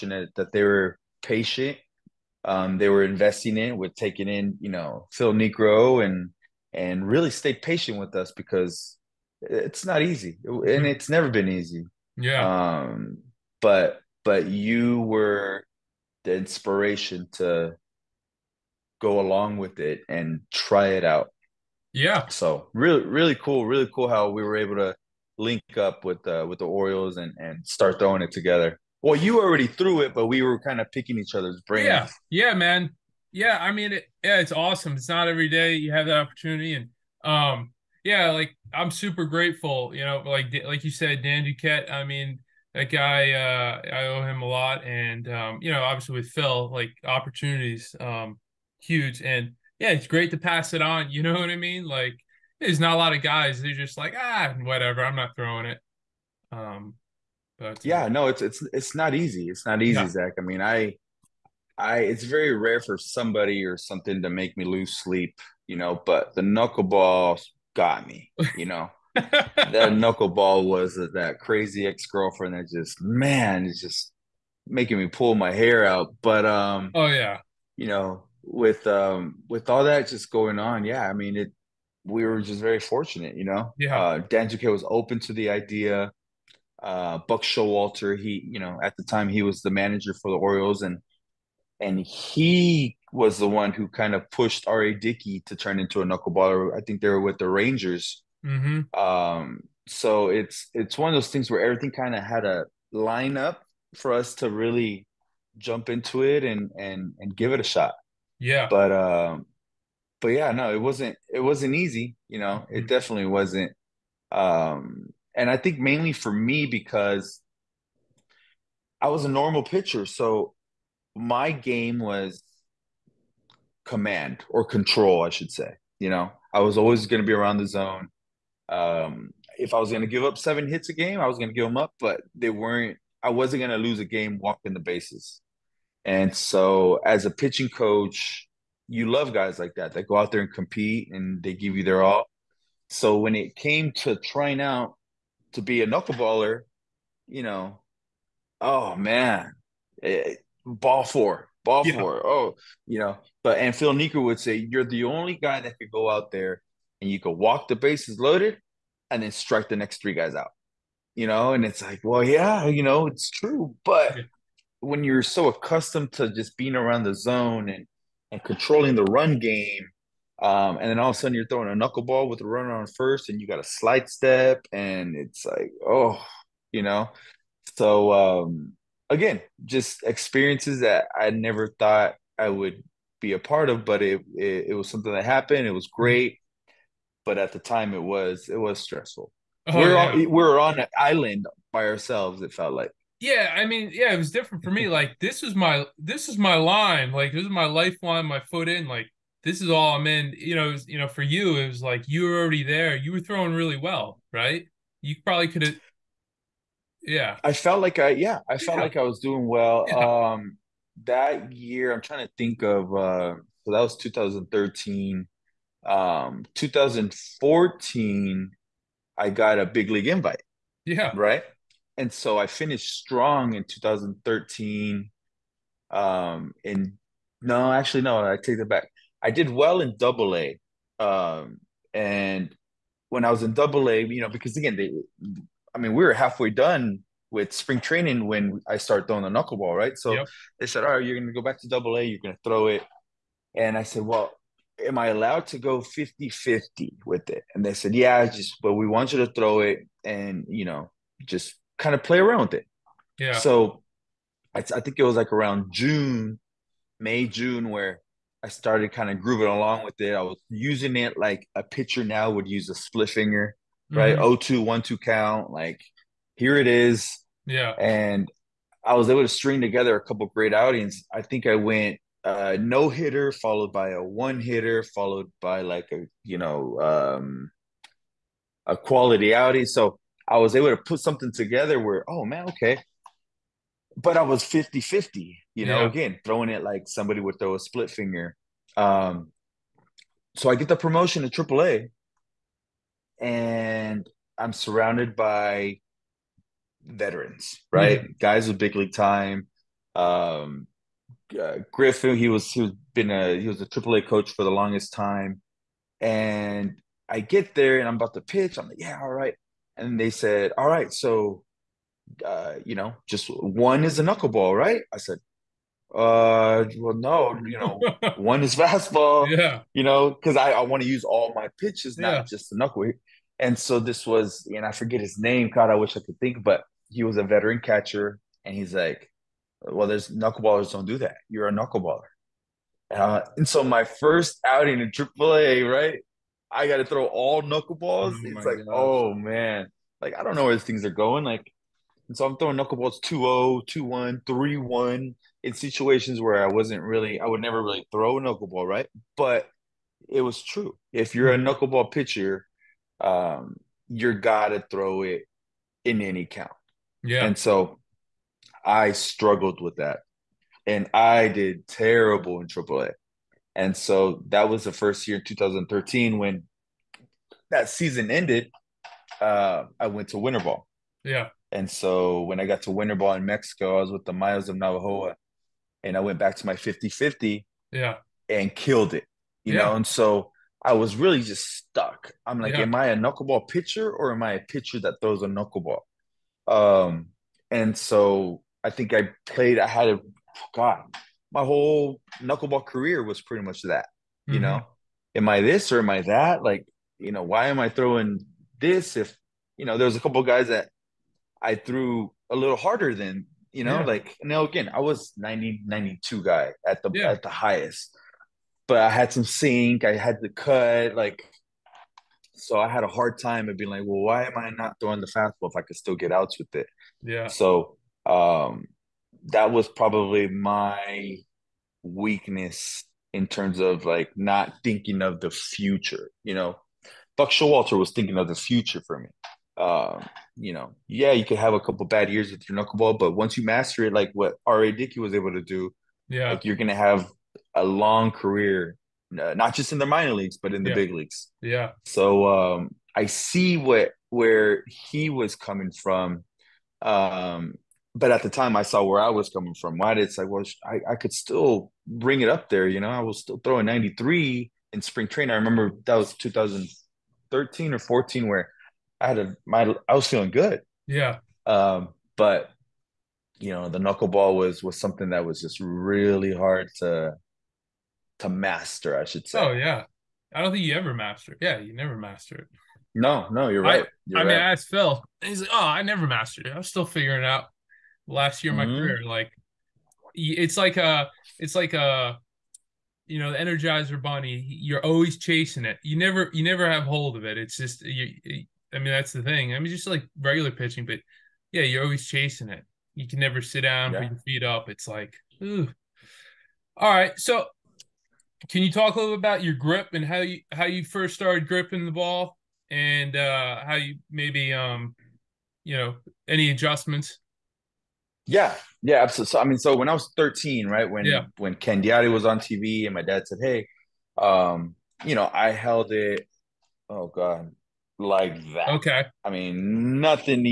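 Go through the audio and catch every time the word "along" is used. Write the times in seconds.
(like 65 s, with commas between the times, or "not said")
19 s, 259 s.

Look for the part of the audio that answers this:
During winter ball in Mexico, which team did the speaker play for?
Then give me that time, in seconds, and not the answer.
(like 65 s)
374 s.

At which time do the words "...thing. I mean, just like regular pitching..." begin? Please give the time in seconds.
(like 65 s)
489 s.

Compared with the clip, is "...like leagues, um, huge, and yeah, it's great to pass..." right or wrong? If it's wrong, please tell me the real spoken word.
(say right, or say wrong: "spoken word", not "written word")
wrong: "opportunities", not "leagues".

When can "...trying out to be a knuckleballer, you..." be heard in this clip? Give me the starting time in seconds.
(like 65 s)
144 s.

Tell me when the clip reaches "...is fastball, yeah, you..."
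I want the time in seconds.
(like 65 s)
318 s.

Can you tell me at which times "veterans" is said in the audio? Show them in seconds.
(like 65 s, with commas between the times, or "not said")
296 s, 327 s.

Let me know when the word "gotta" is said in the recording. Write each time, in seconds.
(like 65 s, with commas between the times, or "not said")
354 s.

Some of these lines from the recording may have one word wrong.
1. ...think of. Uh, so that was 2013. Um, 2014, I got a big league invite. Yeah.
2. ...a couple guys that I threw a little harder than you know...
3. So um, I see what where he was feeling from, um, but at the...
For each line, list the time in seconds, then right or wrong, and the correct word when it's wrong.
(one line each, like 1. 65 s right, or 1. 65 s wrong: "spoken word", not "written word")
1. 212 s right
2. 399 s right
3. 441 s wrong: "coming", not "feeling".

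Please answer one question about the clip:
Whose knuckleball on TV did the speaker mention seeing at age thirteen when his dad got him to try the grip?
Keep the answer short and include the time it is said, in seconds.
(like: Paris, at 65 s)
Candiotti, at 511 s.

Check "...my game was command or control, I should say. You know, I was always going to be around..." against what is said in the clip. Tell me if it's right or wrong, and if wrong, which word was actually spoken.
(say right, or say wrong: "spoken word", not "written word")
right.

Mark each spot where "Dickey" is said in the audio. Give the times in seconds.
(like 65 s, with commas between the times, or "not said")
94 s, 434 s.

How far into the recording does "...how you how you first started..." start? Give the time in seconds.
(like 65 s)
500 s.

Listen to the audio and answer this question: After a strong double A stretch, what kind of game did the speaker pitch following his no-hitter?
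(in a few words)
one hitter.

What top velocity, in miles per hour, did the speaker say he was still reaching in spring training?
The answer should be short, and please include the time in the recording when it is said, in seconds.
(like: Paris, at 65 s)
93, at 453 s.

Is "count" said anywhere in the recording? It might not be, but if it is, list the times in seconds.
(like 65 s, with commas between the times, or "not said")
264 s, 356 s.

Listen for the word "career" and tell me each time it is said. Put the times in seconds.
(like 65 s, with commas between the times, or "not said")
392 s, 438 s, 478 s.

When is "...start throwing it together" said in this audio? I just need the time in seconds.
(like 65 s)
27 s.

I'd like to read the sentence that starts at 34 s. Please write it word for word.
It's not every day you have that opportunity, and um, yeah, like I'm super grateful.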